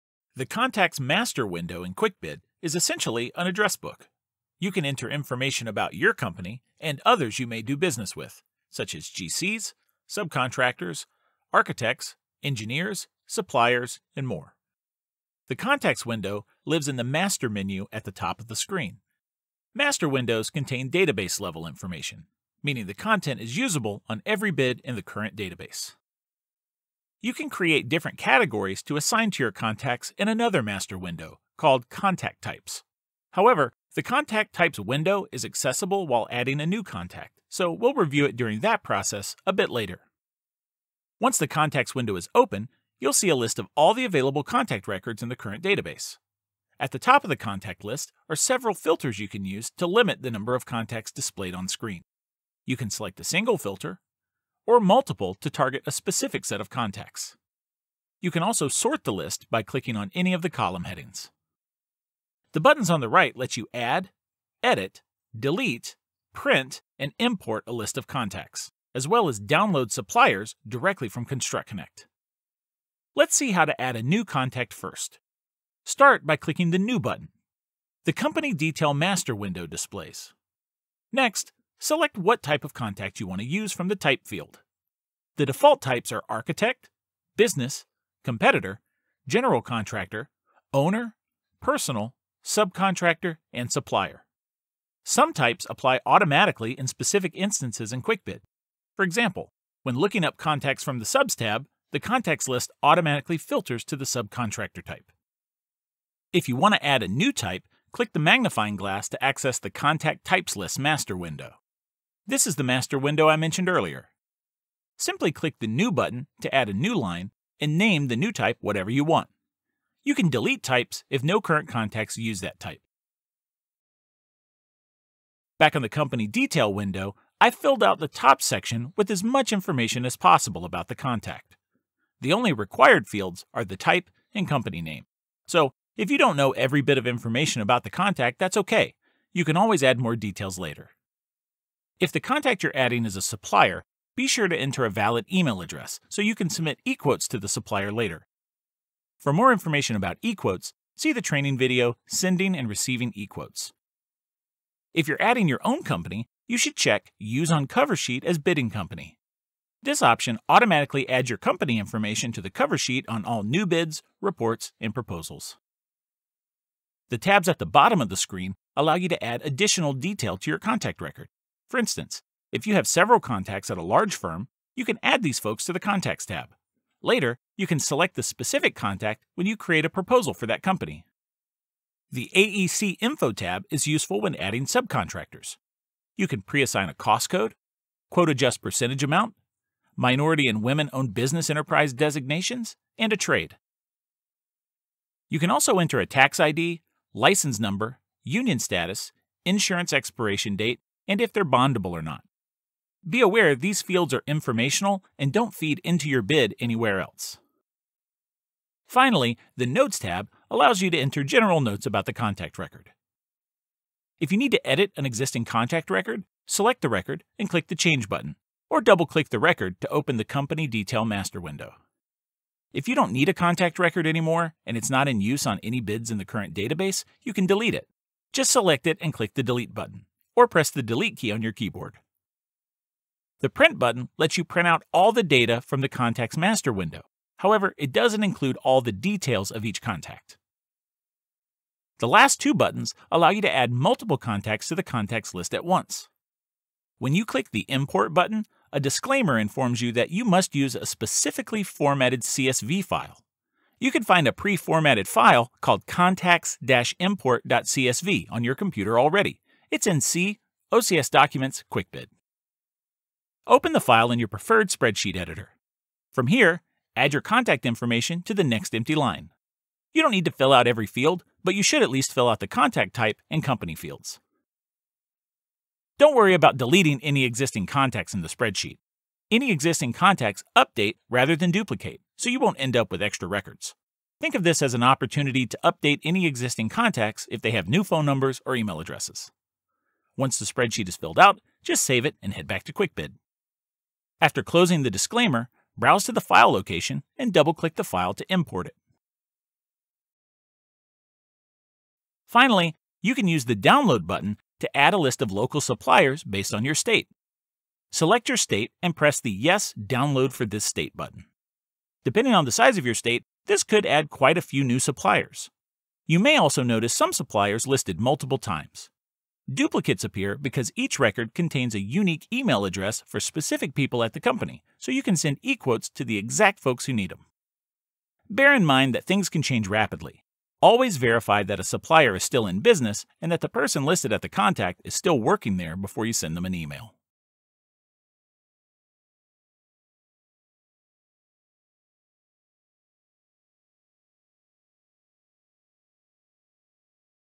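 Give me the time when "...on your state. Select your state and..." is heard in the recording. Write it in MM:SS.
05:06.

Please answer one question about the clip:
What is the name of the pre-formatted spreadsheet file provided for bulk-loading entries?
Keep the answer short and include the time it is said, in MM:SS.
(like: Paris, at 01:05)
contacts-import.csv, at 04:15.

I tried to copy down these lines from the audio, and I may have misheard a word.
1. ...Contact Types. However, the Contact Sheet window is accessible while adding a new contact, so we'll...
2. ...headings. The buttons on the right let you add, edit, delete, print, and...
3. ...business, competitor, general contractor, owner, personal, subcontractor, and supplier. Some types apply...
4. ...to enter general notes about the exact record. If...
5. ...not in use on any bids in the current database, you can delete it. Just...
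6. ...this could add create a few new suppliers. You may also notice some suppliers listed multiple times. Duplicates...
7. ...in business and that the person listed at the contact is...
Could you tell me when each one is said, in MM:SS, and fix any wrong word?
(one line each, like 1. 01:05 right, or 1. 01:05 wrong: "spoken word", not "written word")
1. 00:31 wrong: "Types", not "Sheet"
2. 01:00 right
3. 01:27 right
4. 03:30 wrong: "contact", not "exact"
5. 03:44 right
6. 05:13 wrong: "quite", not "create"
7. 05:32 right.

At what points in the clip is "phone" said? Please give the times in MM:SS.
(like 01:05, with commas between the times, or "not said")
04:47.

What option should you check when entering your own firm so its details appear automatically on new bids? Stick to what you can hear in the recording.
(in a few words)
Use on Cover Sheet.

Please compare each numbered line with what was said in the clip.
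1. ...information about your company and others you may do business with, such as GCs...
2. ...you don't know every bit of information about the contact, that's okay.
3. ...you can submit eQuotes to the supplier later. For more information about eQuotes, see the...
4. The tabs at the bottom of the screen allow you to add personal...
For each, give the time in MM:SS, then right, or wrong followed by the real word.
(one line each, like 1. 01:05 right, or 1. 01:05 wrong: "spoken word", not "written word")
1. 00:05 right
2. 02:16 right
3. 02:26 right
4. 02:47 wrong: "additional", not "personal".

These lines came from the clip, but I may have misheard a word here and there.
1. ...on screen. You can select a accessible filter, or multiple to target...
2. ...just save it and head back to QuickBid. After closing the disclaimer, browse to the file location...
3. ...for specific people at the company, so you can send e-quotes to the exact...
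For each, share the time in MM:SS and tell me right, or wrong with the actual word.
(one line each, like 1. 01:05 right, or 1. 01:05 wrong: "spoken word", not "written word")
1. 00:51 wrong: "single", not "accessible"
2. 04:51 right
3. 05:23 right.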